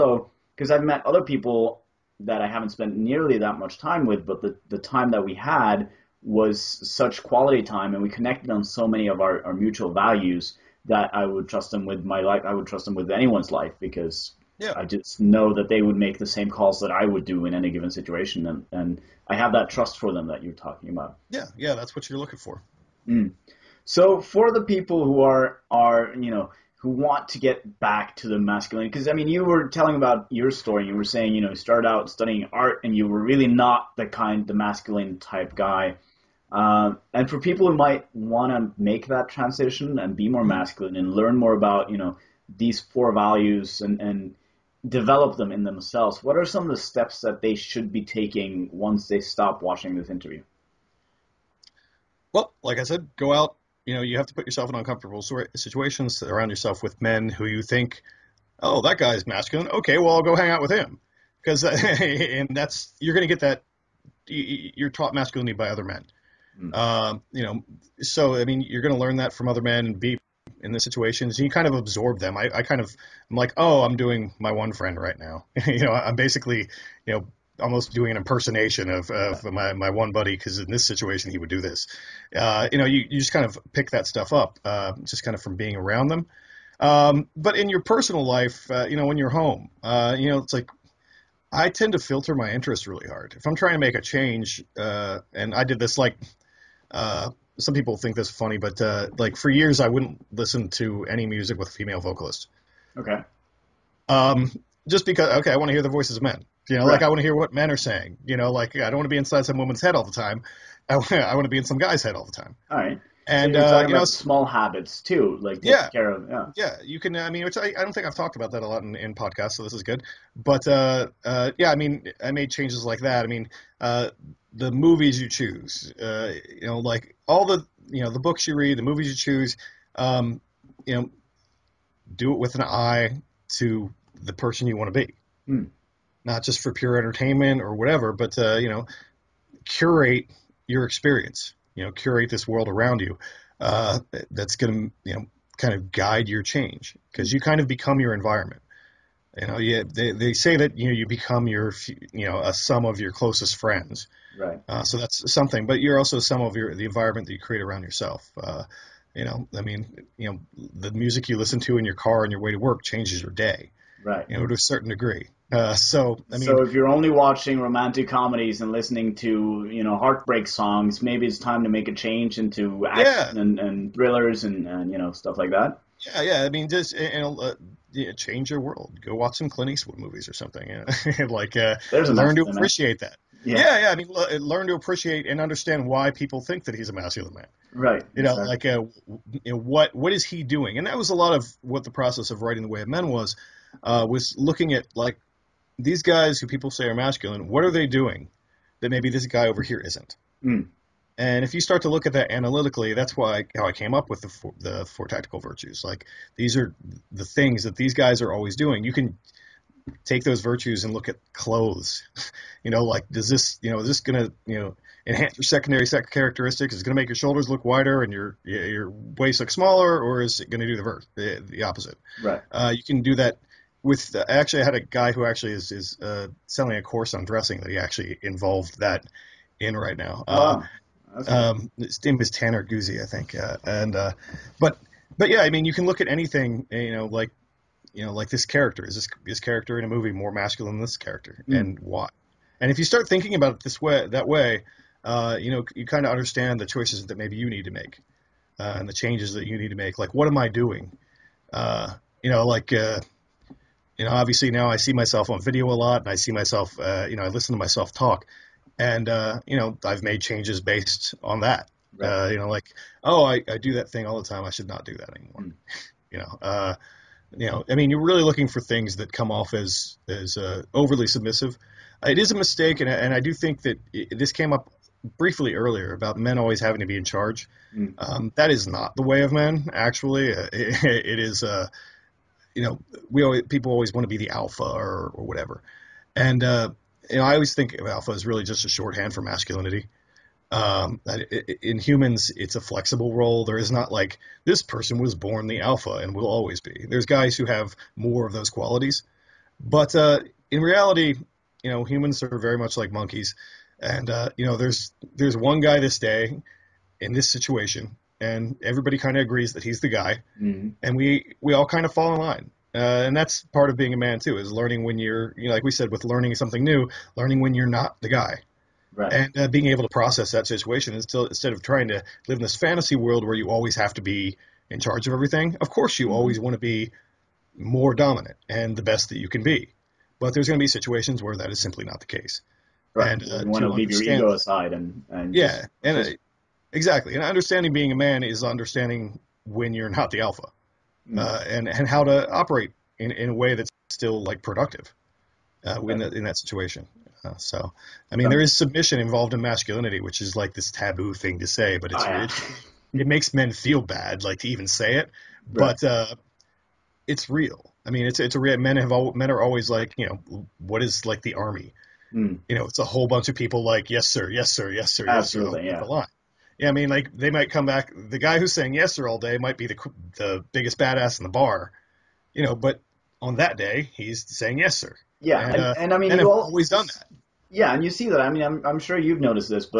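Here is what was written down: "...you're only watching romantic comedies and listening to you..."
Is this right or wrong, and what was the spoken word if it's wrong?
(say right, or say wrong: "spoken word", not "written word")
right.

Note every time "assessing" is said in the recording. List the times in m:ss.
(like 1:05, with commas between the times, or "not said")
not said.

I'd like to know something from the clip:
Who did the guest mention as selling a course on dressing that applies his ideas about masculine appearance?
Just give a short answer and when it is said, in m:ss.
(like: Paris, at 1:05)
Tanner Guzy, at 3:52.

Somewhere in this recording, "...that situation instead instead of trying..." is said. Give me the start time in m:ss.
5:20.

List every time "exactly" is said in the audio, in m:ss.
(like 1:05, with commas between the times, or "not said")
3:08, 5:36.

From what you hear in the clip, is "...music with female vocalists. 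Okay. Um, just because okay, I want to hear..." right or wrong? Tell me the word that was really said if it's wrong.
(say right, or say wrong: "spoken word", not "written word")
right.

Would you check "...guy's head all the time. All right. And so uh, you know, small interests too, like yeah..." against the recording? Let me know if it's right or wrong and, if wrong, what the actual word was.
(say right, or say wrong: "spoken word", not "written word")
wrong: "habits", not "interests".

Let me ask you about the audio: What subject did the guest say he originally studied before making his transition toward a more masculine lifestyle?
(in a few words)
Art.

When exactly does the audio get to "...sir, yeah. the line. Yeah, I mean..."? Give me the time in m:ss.
6:05.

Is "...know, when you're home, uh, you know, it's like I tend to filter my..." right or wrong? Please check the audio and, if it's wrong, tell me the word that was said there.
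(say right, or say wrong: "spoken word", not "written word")
right.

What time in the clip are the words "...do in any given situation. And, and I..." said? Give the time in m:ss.
0:17.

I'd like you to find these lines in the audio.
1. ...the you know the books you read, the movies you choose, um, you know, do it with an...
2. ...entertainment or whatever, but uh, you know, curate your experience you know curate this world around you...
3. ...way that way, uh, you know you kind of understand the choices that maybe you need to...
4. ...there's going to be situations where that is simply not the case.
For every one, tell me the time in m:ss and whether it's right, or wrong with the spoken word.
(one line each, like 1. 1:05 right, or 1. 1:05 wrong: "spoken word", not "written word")
1. 2:07 right
2. 2:16 right
3. 4:03 right
4. 5:30 right.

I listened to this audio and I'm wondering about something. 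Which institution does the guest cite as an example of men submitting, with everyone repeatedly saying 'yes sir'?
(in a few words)
The army.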